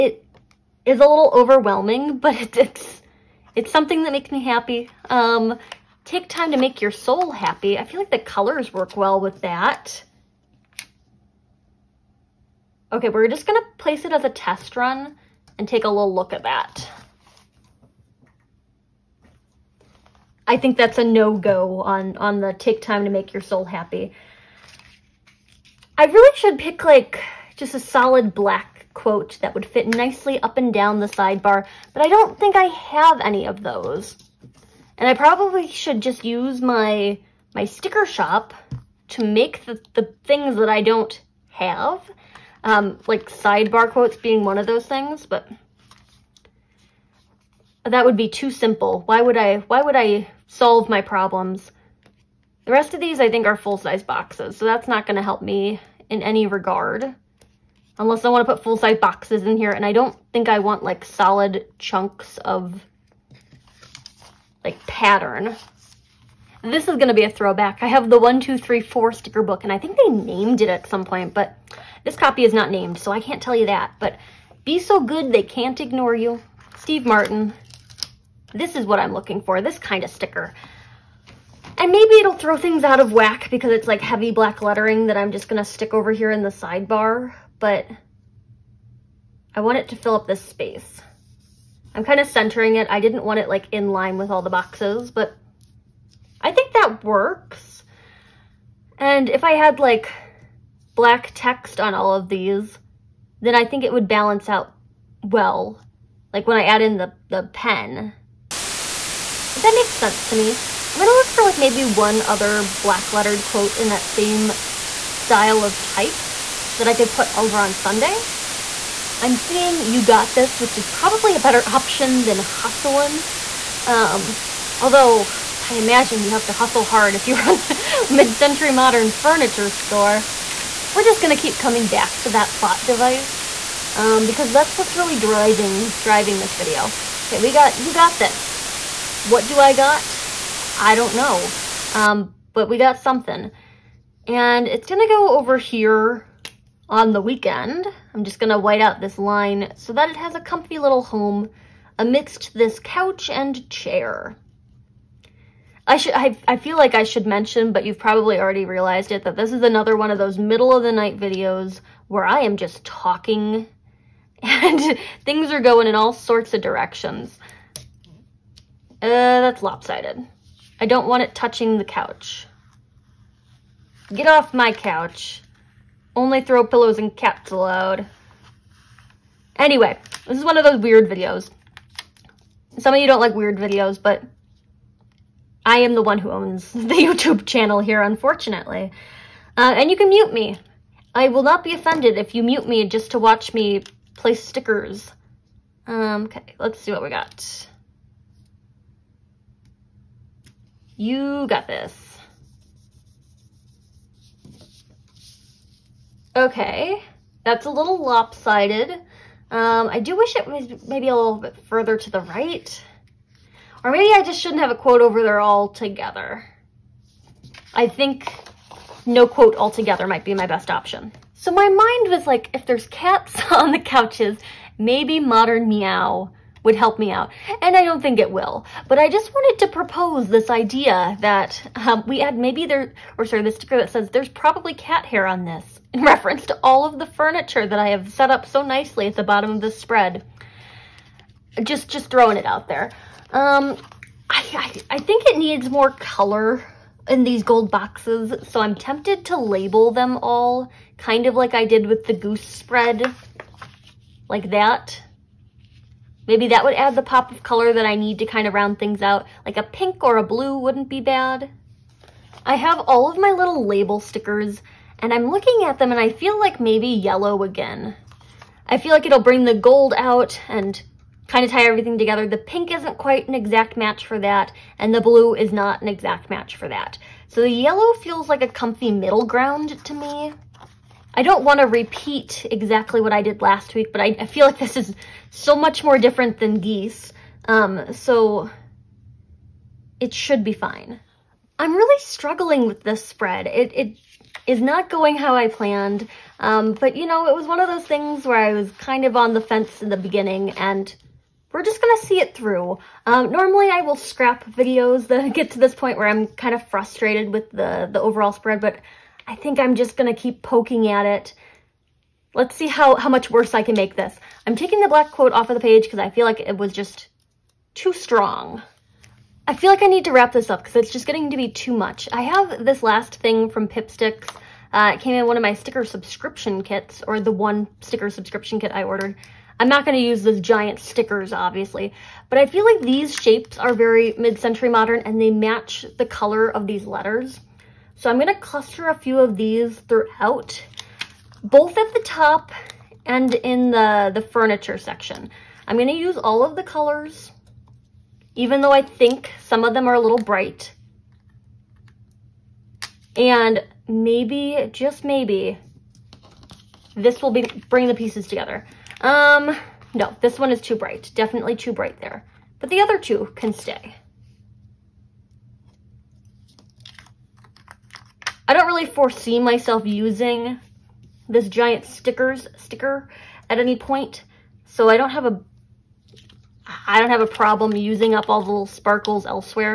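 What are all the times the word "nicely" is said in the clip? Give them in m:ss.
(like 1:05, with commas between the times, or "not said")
0:29, 3:58.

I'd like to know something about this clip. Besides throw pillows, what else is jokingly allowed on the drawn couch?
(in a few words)
caps.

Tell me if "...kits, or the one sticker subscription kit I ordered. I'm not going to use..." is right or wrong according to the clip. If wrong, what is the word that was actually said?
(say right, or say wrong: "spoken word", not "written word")
right.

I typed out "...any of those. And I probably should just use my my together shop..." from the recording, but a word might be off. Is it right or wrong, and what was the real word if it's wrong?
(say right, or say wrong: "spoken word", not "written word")
wrong: "sticker", not "together".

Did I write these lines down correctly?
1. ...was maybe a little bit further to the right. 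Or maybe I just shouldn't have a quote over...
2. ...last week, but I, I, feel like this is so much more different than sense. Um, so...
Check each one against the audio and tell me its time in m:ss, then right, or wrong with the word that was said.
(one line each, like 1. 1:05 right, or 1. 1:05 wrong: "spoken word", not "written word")
1. 3:30 right
2. 4:43 wrong: "geese", not "sense".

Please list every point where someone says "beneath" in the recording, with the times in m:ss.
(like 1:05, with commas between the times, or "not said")
not said.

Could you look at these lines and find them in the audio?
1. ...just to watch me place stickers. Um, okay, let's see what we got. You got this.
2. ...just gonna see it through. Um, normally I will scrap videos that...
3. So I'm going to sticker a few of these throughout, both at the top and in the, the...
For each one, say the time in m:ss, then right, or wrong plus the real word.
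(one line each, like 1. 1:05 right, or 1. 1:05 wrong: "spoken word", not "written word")
1. 3:12 right
2. 5:01 right
3. 5:37 wrong: "cluster", not "sticker".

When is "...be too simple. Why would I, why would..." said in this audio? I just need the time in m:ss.
0:48.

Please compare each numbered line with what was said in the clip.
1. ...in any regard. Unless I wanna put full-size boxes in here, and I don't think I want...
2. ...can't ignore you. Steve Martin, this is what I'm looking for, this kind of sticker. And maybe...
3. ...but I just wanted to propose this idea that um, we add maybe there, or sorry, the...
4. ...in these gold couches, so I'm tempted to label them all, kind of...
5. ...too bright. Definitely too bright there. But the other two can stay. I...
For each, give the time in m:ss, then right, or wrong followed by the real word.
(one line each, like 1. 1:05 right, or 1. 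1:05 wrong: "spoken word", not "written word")
1. 0:56 right
2. 1:15 right
3. 3:48 right
4. 4:07 wrong: "boxes", not "couches"
5. 6:00 right.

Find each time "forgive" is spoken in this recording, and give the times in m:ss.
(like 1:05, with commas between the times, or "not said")
not said.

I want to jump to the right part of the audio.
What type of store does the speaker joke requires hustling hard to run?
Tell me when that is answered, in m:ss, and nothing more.
2:08.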